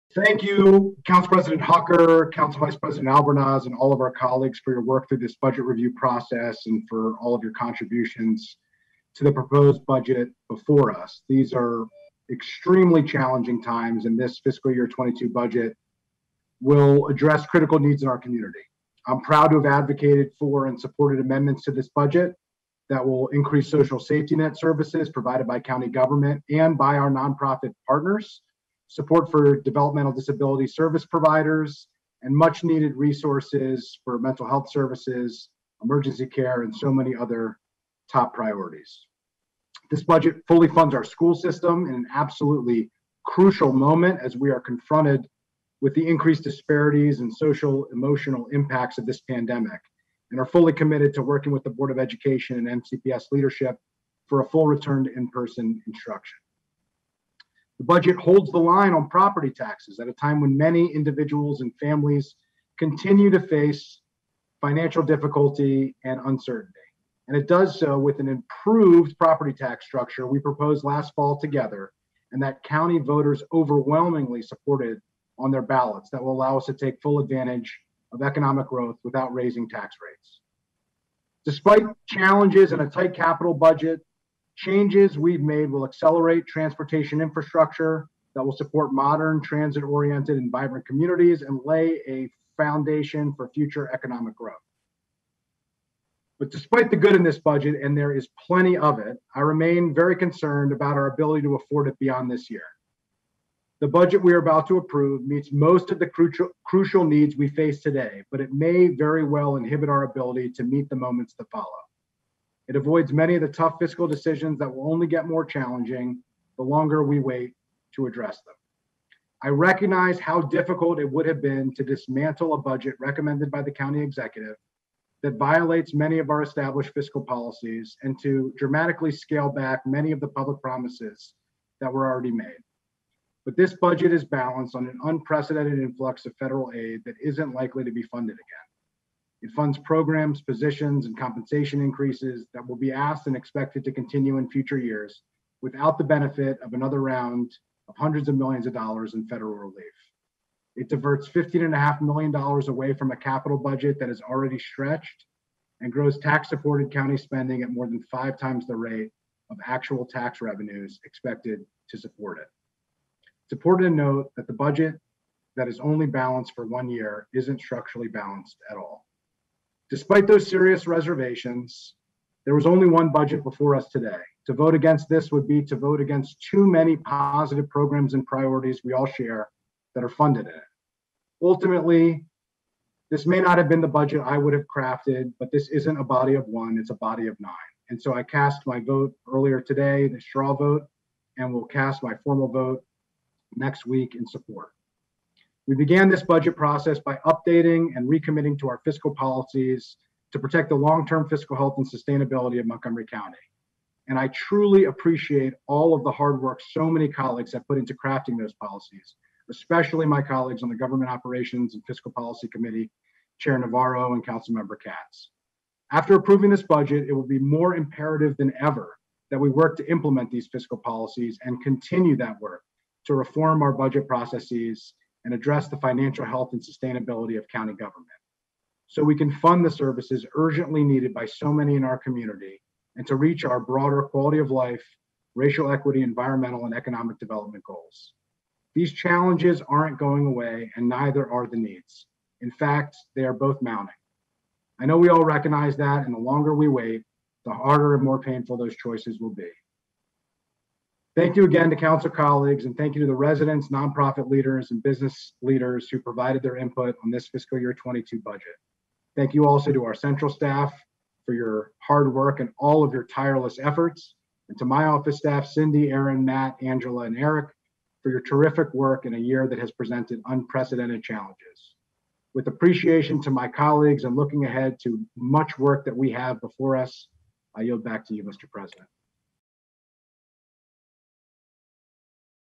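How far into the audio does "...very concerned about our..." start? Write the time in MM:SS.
01:39.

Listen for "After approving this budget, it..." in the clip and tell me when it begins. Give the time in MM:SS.
03:35.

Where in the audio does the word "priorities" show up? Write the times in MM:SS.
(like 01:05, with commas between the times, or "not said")
00:38, 02:58.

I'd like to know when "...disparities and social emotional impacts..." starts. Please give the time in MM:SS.
00:46.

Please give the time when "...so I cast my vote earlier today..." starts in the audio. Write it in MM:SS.
03:08.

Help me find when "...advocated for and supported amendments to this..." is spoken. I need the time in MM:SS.
00:19.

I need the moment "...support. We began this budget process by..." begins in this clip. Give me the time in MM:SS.
03:14.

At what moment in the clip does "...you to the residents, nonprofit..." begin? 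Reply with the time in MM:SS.
04:12.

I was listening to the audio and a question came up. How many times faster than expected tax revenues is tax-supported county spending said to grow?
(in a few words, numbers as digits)
five times.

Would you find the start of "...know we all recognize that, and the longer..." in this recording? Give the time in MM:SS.
04:04.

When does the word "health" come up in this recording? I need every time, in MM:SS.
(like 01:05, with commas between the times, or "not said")
00:34, 03:21, 03:46.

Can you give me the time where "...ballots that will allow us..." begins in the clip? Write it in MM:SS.
01:15.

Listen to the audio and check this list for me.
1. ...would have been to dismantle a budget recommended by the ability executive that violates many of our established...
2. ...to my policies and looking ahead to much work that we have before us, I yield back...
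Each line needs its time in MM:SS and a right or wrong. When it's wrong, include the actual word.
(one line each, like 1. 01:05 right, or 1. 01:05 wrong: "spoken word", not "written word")
1. 02:01 wrong: "county", not "ability"
2. 04:33 wrong: "colleagues", not "policies".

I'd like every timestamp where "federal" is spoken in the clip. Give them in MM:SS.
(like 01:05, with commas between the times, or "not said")
02:16, 02:29.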